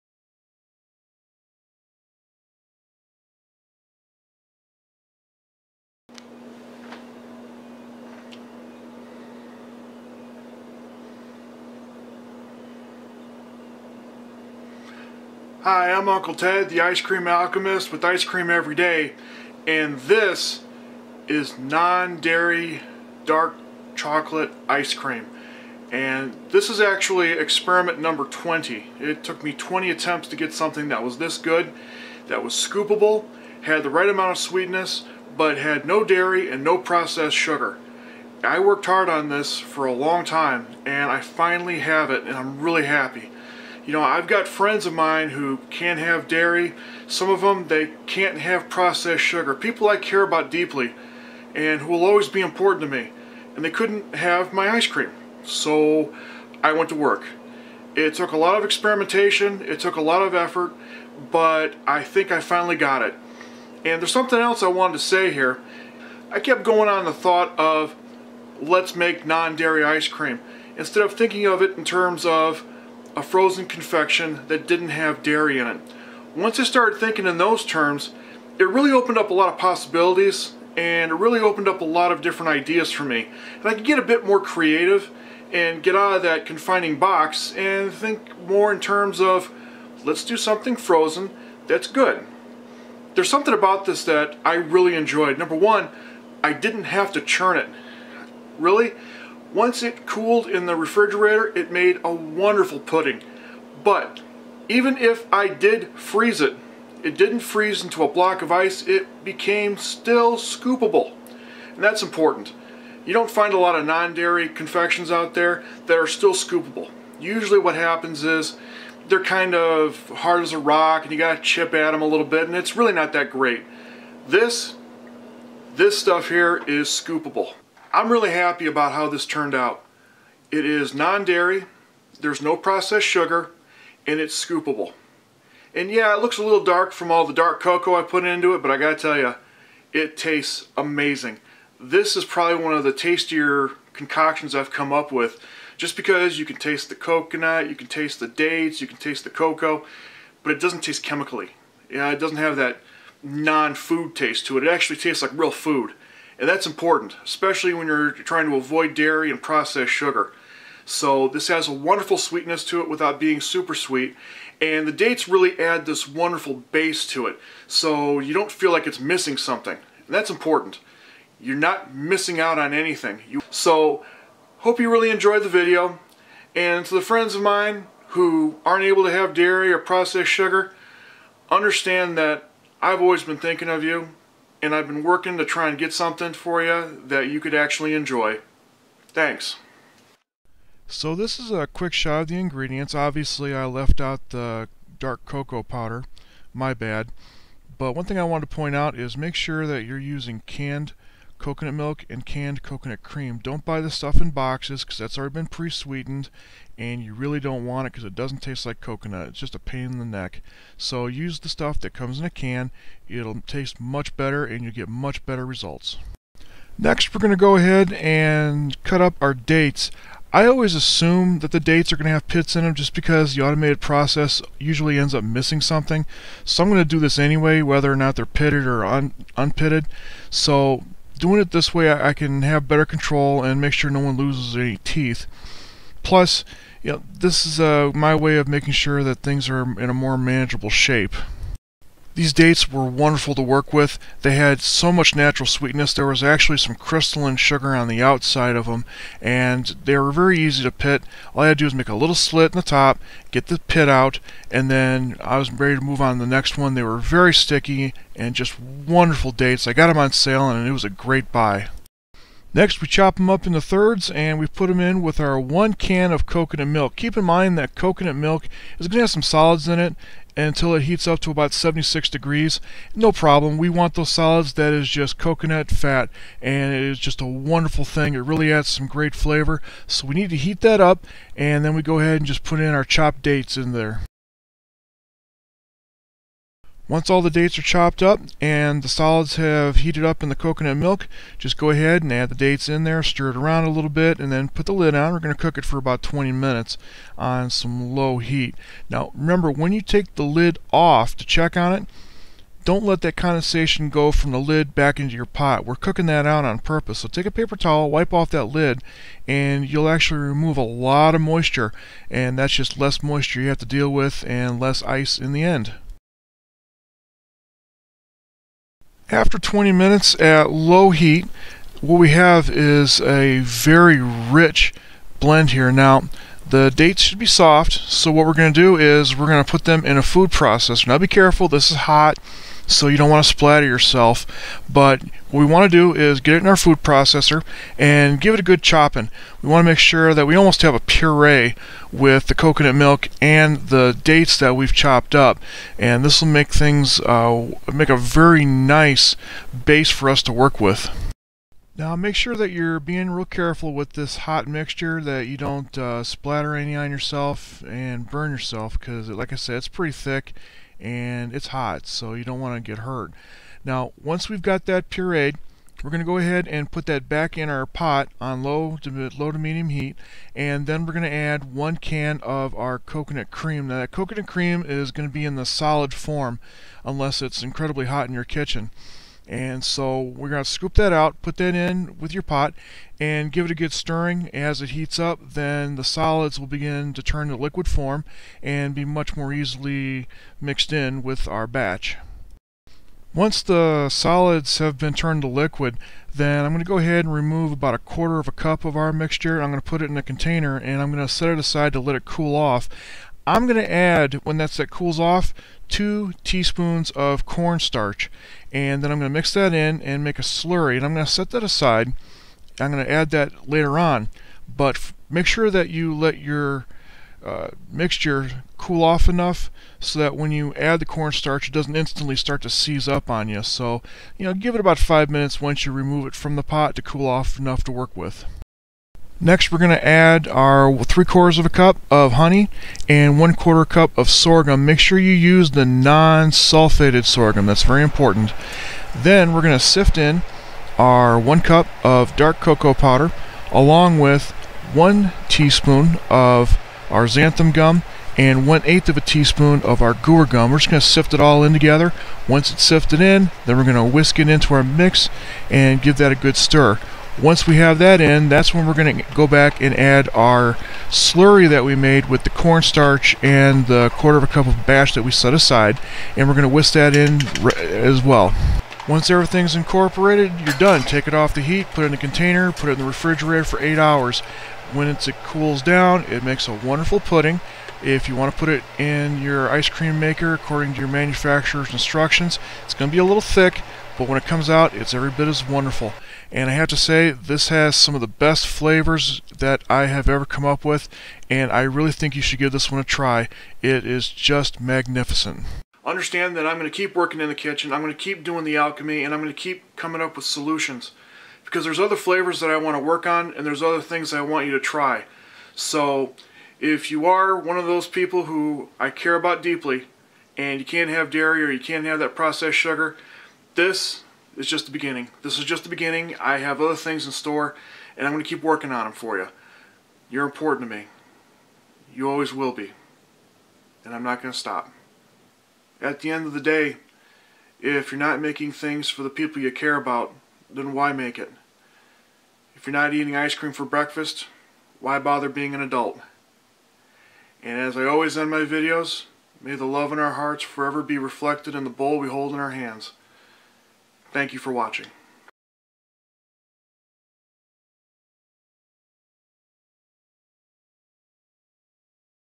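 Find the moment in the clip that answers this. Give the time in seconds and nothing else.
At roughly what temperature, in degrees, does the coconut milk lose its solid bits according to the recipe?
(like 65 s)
271 s.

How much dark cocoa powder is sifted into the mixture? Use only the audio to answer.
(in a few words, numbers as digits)
1 cup.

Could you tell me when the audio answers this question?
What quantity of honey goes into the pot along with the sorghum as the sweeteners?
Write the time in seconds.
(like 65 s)
430 s.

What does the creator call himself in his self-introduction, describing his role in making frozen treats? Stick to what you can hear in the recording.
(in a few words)
Ice Cream Alchemist.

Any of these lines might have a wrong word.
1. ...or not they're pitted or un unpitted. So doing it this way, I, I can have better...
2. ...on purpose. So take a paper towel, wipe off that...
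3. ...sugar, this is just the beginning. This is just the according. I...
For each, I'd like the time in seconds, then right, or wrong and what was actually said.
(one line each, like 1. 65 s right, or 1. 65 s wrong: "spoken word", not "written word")
1. 227 s right
2. 306 s right
3. 512 s wrong: "beginning", not "according".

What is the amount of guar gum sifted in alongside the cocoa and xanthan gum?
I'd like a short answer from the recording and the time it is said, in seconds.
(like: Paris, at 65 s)
1/8 teaspoon, at 448 s.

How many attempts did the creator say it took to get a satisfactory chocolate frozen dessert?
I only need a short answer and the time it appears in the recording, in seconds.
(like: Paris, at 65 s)
20, at 29 s.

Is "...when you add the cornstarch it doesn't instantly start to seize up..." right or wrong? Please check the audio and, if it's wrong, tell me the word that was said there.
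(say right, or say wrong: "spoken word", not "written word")
right.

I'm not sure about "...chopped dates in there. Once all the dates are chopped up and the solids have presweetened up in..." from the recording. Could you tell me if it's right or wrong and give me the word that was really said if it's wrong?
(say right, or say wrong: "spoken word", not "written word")
wrong: "heated", not "presweetened".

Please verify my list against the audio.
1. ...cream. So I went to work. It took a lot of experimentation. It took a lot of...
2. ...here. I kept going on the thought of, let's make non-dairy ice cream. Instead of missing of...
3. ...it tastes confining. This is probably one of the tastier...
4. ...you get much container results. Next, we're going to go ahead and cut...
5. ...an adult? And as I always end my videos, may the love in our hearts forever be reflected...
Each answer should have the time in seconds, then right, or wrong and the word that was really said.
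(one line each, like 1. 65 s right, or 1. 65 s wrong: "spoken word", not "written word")
1. 54 s right
2. 65 s wrong: "thinking", not "missing"
3. 139 s wrong: "amazing", not "confining"
4. 214 s wrong: "better", not "container"
5. 535 s right.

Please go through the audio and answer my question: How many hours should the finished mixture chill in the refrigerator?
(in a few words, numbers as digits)
8 hours.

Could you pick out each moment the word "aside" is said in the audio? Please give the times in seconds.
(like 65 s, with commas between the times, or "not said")
401 s, 411 s, 465 s.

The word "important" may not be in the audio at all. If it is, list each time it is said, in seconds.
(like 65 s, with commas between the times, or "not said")
52 s, 112 s, 156 s, 170 s, 437 s, 520 s.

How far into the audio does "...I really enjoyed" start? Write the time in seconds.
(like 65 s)
94 s.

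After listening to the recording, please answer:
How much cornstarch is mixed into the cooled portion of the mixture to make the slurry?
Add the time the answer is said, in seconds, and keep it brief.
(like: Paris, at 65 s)
2 teaspoons, at 405 s.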